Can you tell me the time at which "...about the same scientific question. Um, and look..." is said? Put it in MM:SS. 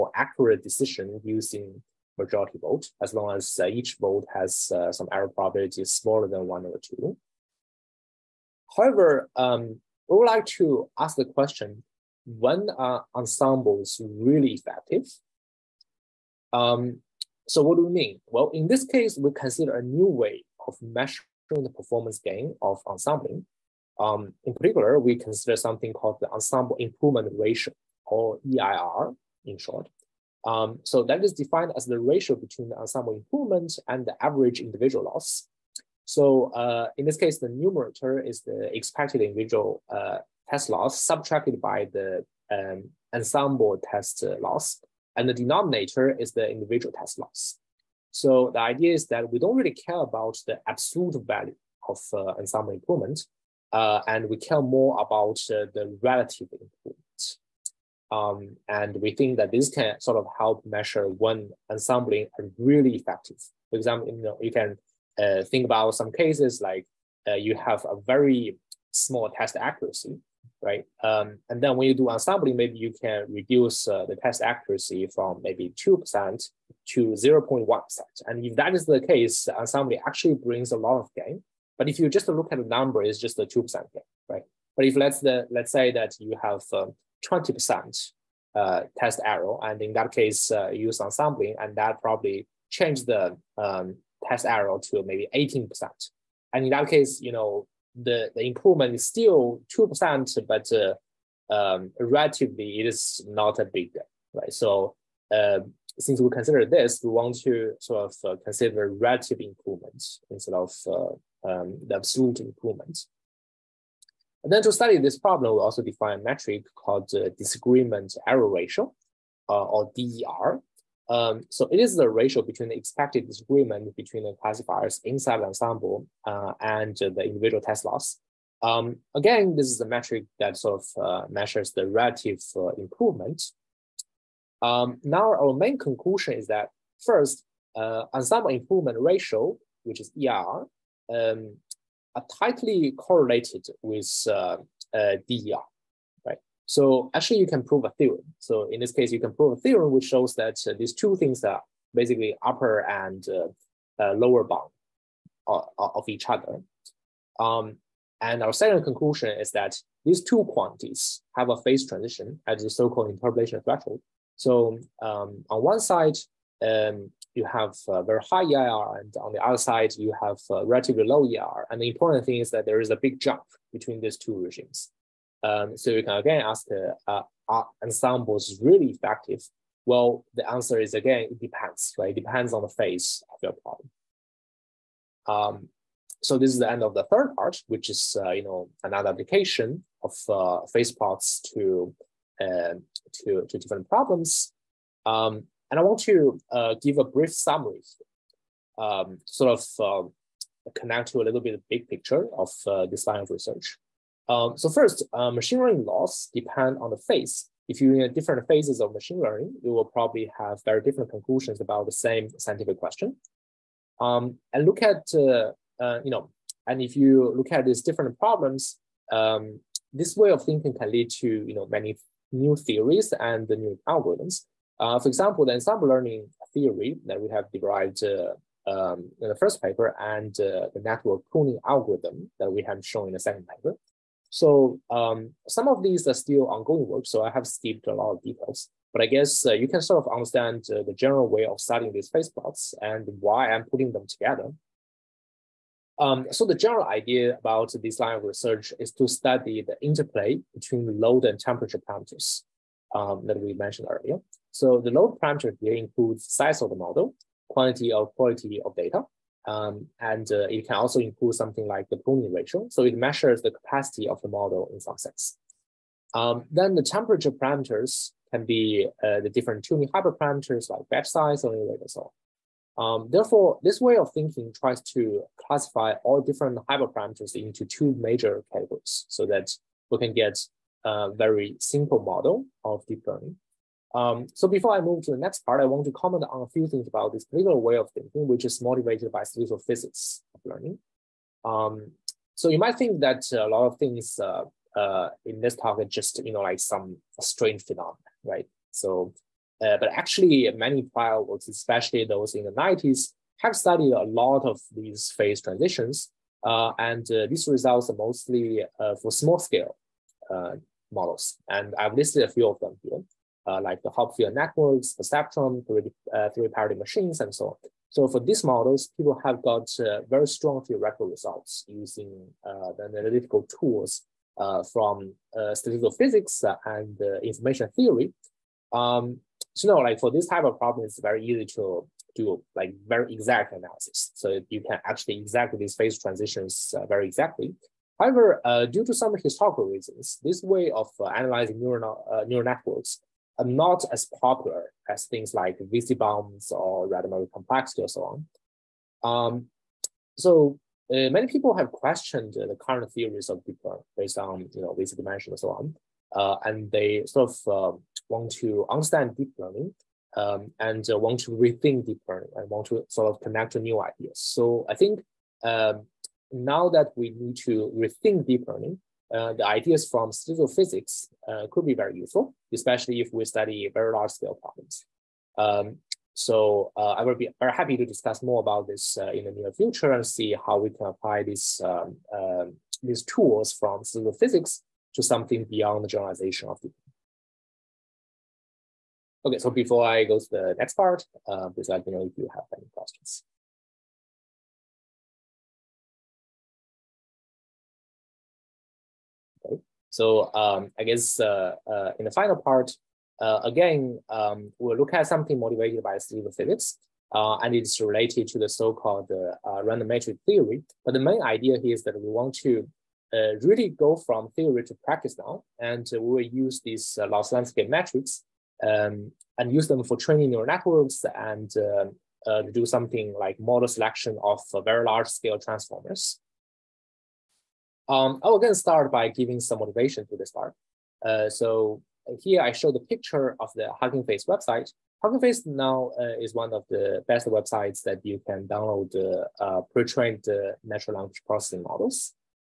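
03:31.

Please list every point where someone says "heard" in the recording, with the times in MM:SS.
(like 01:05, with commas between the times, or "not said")
not said.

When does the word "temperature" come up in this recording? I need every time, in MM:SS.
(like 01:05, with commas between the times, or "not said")
04:11, 04:26.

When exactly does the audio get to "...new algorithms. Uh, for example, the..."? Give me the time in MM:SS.
03:43.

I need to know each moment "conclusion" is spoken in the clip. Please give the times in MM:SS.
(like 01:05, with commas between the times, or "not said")
02:15, 02:38, 03:31.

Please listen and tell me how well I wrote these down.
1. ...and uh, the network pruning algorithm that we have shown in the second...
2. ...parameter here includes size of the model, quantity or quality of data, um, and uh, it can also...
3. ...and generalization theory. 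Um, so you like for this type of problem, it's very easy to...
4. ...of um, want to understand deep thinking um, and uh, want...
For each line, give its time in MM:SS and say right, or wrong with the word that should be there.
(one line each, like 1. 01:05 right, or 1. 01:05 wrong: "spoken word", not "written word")
1. 03:49 right
2. 04:15 right
3. 05:26 wrong: "information", not "generalization"
4. 05:57 wrong: "learning", not "thinking".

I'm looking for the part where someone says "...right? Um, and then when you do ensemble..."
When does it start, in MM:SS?
01:10.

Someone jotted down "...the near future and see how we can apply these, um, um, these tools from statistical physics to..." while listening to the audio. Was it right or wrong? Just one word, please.
right.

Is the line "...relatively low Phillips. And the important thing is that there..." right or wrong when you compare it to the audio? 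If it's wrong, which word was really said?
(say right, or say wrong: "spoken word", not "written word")
wrong: "EIR", not "Phillips".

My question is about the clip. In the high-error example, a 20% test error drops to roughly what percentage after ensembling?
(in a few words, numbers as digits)
18%.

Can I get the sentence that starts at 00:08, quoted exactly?
However, um, we would like to ask the question: When are ensembles really effective?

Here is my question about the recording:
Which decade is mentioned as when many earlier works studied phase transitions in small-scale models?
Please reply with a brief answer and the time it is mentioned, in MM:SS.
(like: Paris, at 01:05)
The 90s, at 05:02.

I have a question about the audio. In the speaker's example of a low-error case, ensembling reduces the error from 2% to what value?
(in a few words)
0.1%.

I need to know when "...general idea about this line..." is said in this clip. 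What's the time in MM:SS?
04:06.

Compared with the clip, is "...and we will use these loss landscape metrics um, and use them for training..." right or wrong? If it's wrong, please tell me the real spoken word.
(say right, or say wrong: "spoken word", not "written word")
right.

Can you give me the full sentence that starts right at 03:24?
Um, so first, uh, machine learning laws depend on the phase.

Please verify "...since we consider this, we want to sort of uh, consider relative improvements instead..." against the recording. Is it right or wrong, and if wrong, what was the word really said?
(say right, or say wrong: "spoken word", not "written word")
right.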